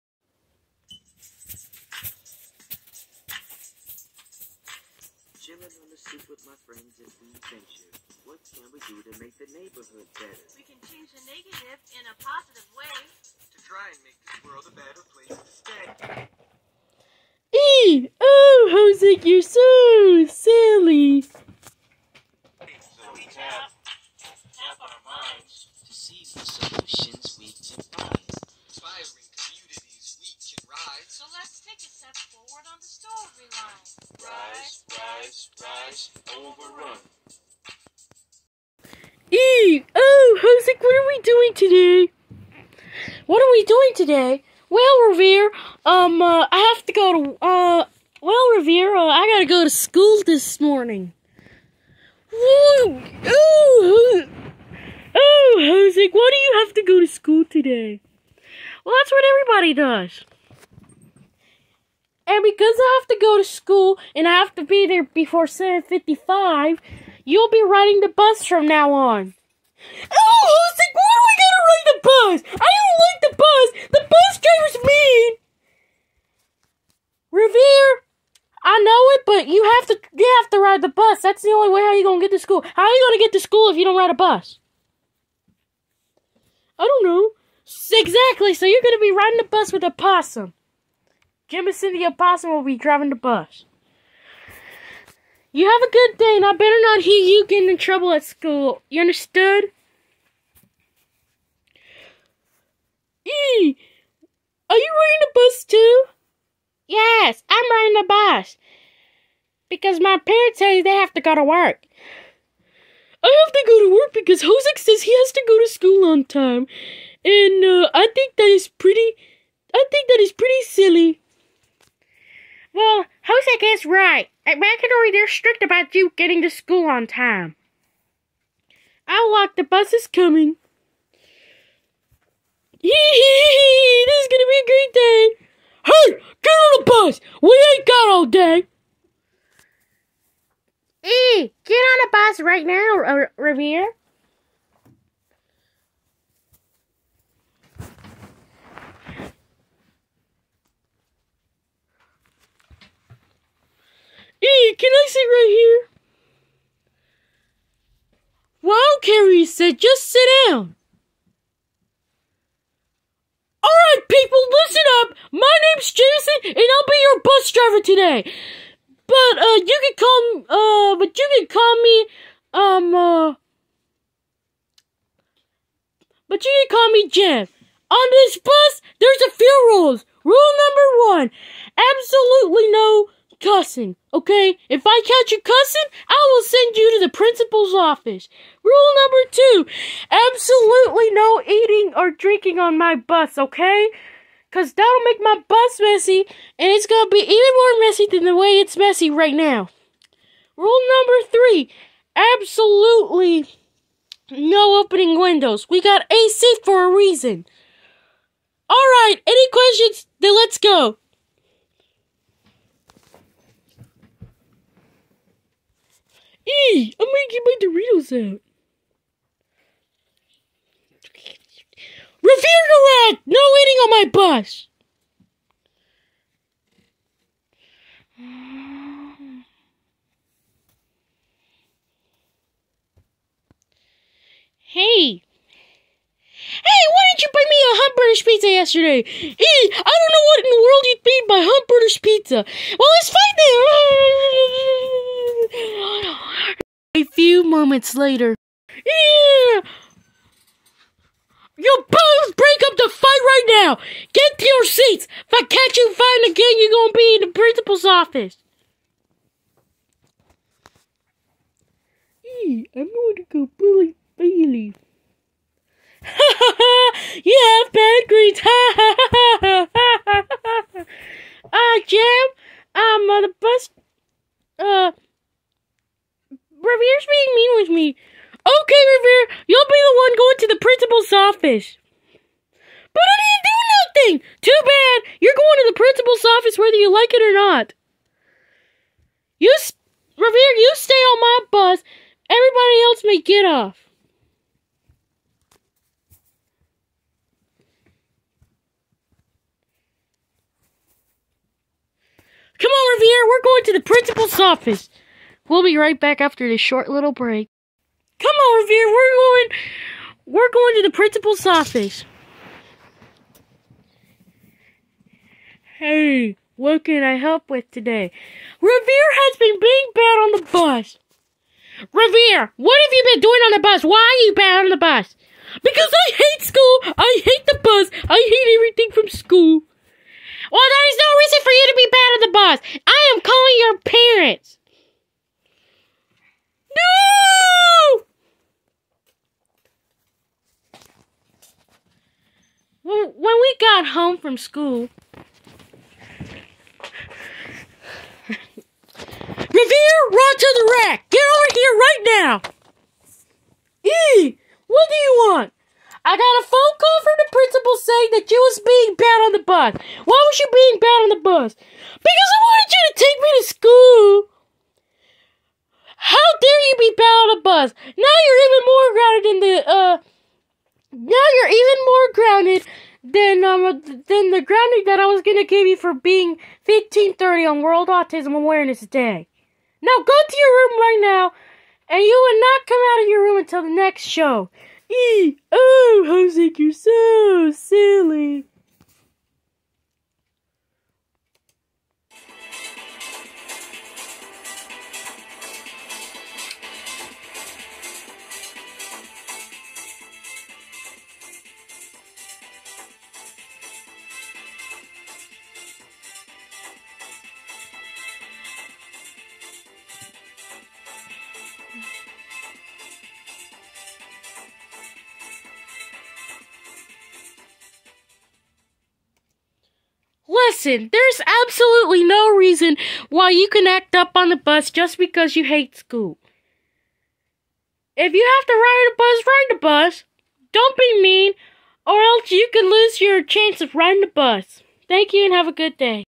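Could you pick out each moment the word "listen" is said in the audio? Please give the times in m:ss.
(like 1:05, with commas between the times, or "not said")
2:44, 7:00.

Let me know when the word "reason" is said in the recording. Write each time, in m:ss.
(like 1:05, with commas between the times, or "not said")
3:26, 7:02.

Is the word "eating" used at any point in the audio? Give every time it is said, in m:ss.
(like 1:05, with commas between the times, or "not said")
3:11, 3:43.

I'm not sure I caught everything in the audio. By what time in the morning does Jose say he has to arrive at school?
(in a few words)
7:55.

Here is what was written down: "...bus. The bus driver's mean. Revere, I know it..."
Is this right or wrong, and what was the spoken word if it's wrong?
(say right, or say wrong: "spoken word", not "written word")
right.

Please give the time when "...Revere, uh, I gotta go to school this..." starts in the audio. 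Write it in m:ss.
0:48.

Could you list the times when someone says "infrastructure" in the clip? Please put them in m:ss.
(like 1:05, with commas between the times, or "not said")
not said.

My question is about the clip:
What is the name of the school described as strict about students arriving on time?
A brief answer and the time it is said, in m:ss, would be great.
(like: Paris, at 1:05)
McIndory, at 2:04.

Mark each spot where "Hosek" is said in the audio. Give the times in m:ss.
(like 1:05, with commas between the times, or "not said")
1:54, 2:03.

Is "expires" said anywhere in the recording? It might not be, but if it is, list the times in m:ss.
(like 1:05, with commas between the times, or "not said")
not said.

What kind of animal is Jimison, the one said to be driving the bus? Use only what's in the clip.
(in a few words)
opossum.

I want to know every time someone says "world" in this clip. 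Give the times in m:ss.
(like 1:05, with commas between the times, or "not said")
0:14, 4:00, 6:17.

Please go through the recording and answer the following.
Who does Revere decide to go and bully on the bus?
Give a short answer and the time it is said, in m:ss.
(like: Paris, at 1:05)
Bailey, at 4:24.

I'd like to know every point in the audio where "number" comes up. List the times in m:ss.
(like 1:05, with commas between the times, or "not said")
3:00, 3:09, 3:20.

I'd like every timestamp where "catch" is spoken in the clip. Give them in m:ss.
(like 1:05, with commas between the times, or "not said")
3:05, 4:15.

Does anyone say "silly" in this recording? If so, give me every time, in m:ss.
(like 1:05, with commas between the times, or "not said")
2:00, 6:27.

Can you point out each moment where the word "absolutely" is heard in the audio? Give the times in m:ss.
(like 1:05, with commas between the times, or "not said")
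3:01, 3:10, 3:22, 7:01.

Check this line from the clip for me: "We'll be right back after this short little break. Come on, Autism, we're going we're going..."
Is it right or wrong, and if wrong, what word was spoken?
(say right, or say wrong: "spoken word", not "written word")
wrong: "Revere", not "Autism".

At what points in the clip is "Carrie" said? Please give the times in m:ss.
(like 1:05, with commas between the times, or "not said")
2:39.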